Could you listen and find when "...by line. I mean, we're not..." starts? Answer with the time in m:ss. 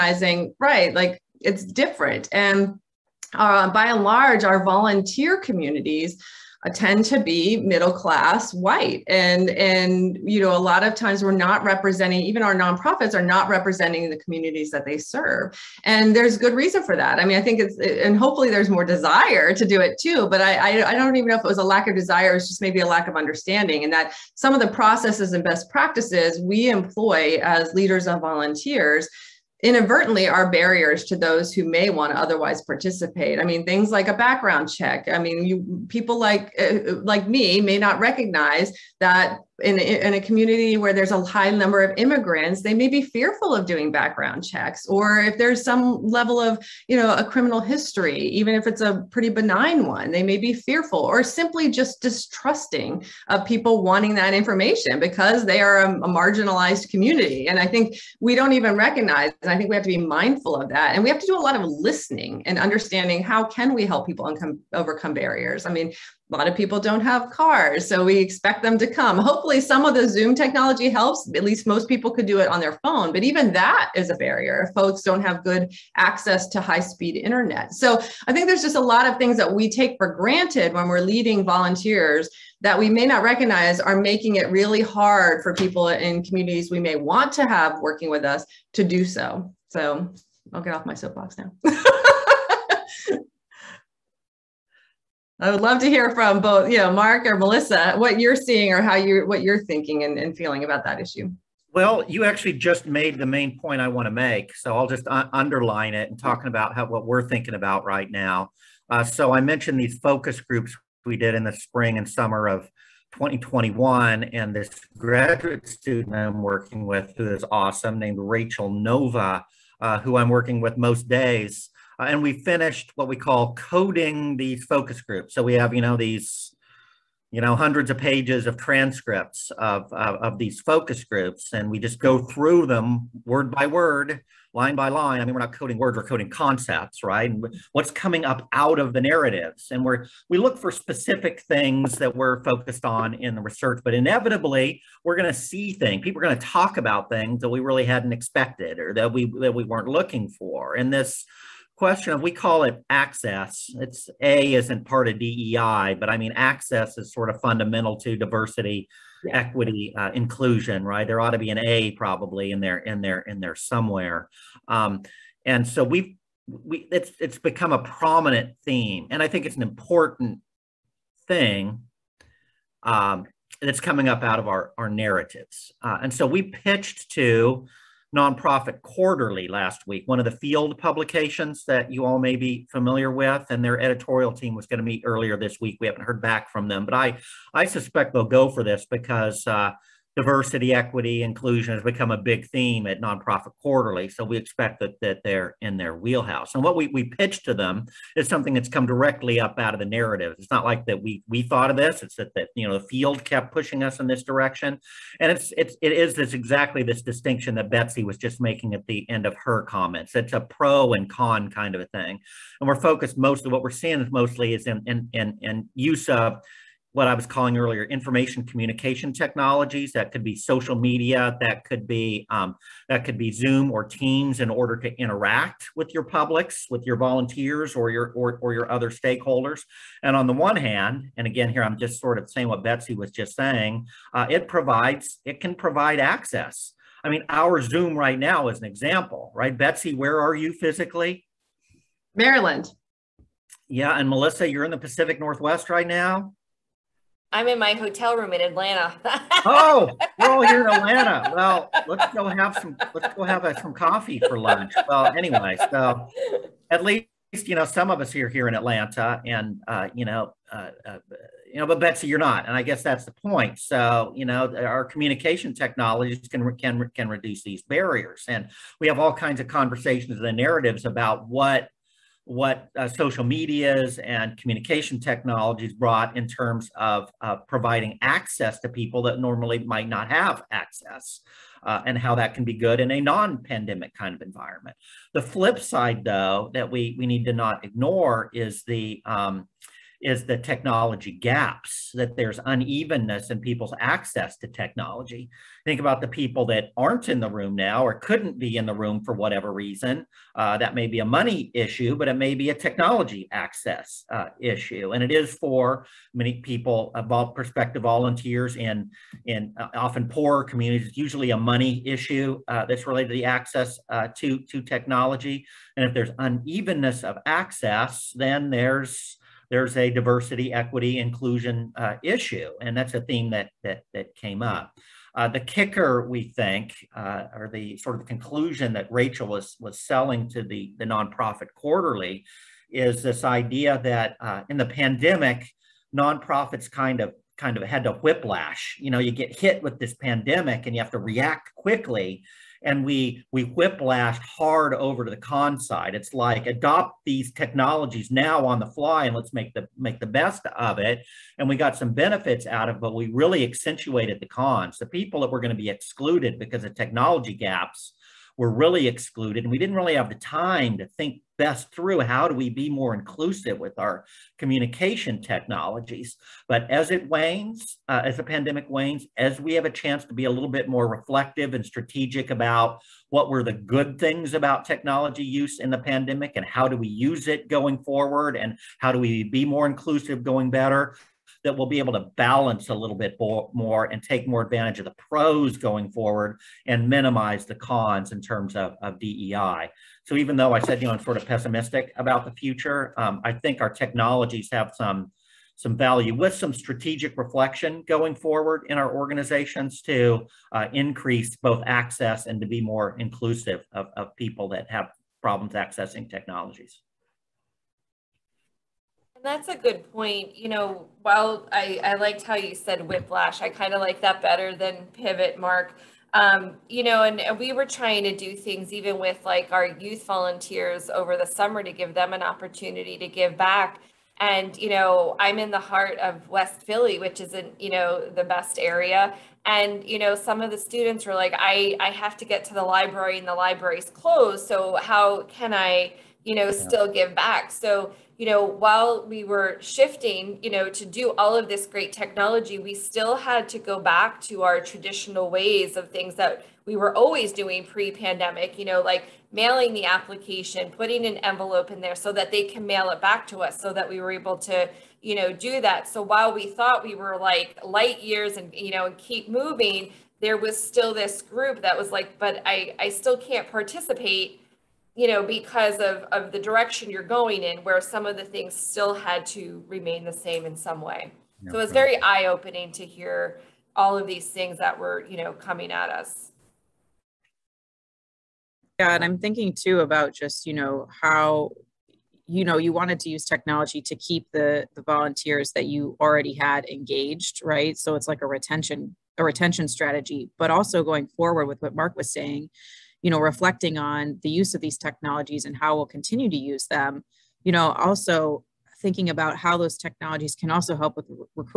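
2:14.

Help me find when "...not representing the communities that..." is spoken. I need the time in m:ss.
0:13.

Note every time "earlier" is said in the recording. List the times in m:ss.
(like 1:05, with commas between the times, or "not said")
3:05, 3:37.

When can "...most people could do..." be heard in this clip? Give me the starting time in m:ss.
1:11.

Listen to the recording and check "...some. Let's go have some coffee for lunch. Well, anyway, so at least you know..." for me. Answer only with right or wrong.
right.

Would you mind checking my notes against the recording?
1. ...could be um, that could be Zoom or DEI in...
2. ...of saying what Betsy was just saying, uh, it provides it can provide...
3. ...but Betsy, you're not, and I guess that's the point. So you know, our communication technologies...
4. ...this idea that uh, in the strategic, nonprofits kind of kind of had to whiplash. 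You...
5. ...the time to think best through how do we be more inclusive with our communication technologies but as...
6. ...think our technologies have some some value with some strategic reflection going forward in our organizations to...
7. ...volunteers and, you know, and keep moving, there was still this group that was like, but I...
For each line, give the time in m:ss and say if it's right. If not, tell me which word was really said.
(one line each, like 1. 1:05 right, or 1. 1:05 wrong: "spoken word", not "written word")
1. 3:41 wrong: "Teams", not "DEI"
2. 3:52 right
3. 4:21 right
4. 5:33 wrong: "pandemic", not "strategic"
5. 6:00 right
6. 6:33 right
7. 7:38 wrong: "years", not "volunteers".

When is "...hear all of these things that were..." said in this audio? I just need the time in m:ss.
7:52.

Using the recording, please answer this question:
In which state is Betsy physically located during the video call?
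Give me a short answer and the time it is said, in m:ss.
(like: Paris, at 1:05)
Maryland, at 4:02.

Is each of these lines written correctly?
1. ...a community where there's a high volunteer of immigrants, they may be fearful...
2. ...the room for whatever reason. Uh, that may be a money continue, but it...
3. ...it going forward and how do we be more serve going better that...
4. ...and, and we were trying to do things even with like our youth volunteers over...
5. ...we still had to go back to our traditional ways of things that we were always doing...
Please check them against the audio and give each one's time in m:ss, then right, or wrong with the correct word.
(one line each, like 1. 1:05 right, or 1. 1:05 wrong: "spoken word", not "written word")
1. 0:40 wrong: "number", not "volunteer"
2. 4:58 wrong: "issue", not "continue"
3. 6:17 wrong: "inclusive", not "serve"
4. 6:57 right
5. 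7:22 right.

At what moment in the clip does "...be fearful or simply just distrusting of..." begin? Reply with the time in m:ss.
0:50.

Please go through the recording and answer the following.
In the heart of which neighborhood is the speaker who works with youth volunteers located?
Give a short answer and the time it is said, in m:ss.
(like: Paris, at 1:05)
West Philly, at 7:06.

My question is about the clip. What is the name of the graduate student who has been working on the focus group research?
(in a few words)
Rachel Nova.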